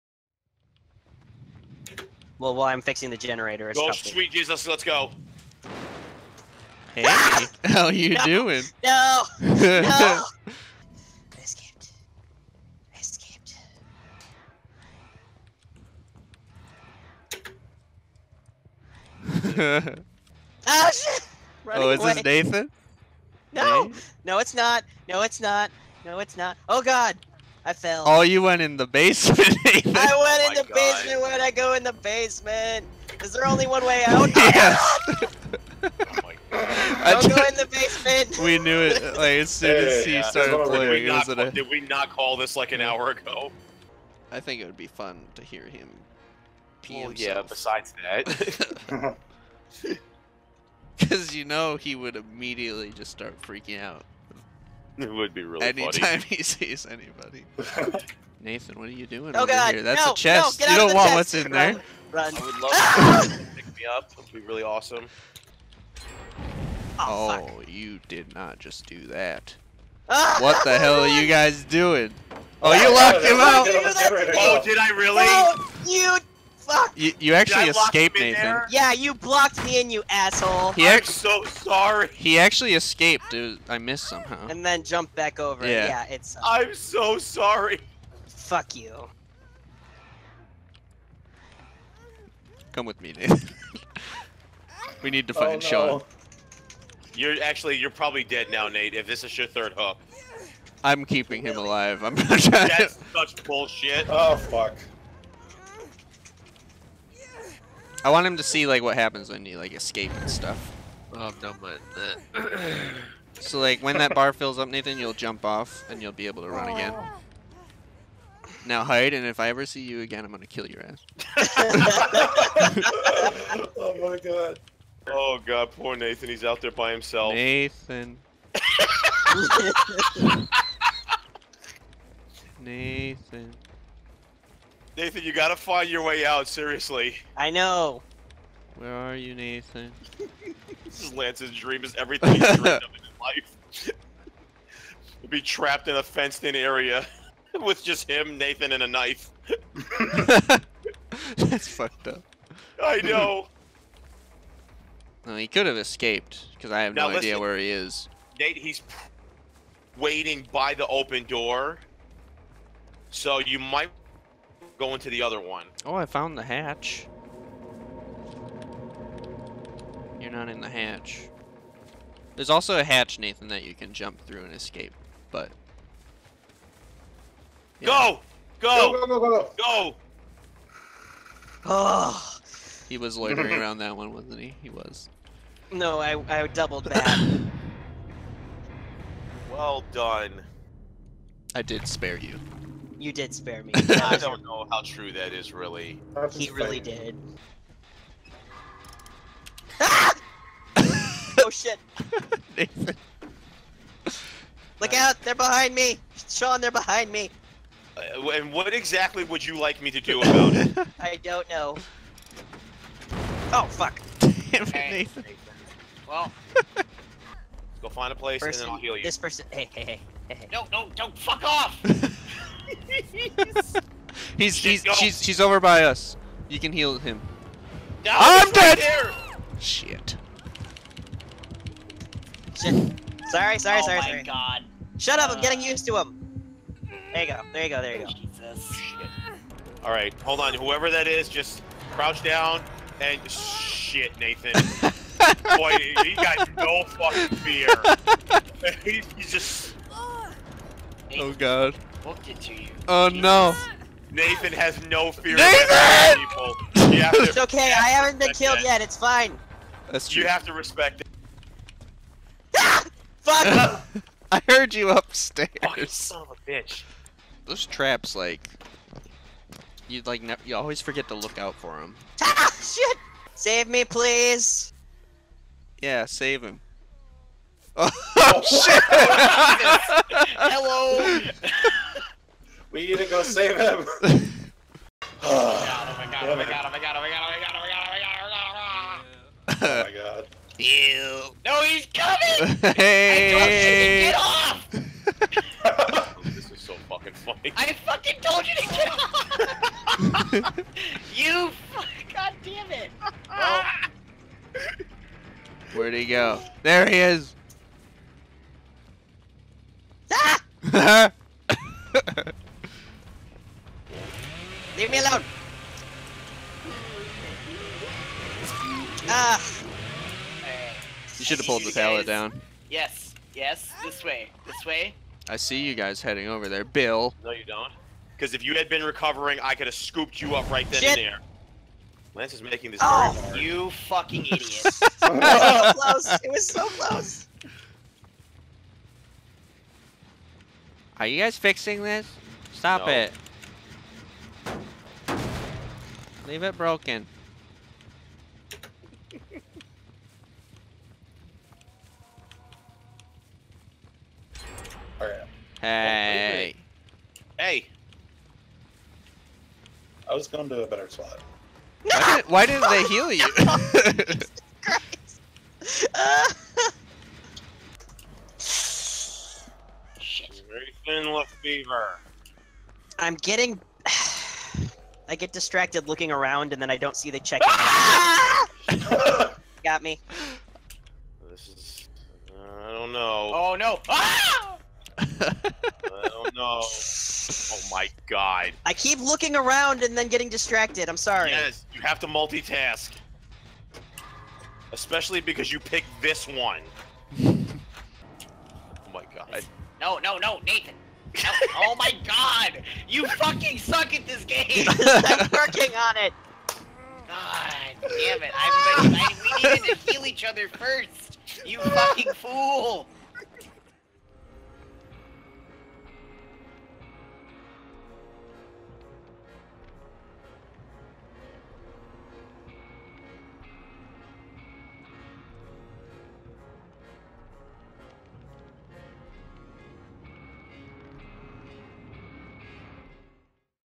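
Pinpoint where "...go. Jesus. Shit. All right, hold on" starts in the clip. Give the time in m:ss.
3:58.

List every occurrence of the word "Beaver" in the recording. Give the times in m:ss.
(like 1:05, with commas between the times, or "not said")
6:11.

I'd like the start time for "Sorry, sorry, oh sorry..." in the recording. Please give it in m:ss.
3:53.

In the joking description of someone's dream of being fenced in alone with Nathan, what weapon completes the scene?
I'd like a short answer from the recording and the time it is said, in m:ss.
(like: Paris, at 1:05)
a knife, at 2:28.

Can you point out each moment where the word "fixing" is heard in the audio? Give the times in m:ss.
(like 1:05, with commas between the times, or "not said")
0:02, 5:41.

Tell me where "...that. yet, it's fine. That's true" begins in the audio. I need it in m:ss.
4:18.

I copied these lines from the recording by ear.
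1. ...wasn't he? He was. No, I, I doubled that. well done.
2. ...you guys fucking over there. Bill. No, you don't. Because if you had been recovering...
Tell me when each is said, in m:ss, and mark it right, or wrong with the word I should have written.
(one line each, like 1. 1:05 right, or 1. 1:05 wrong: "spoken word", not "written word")
1. 3:04 right
2. 5:25 wrong: "heading", not "fucking".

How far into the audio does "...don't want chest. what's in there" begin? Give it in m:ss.
1:00.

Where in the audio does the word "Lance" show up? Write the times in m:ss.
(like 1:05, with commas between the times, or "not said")
2:21, 5:32.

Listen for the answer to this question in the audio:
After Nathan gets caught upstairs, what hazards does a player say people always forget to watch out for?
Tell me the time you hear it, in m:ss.
4:27.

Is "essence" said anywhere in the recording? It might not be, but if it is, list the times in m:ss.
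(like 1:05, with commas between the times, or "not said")
not said.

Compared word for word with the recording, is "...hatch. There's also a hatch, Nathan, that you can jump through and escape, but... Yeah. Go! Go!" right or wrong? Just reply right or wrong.
right.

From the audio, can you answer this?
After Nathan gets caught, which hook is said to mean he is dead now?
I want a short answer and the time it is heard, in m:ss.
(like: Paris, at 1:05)
third hook, at 1:39.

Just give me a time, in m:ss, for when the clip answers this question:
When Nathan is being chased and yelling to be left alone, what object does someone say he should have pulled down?
5:21.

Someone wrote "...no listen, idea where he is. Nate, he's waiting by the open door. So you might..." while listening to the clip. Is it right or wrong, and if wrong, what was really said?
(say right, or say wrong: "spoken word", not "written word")
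right.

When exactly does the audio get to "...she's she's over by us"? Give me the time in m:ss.
3:44.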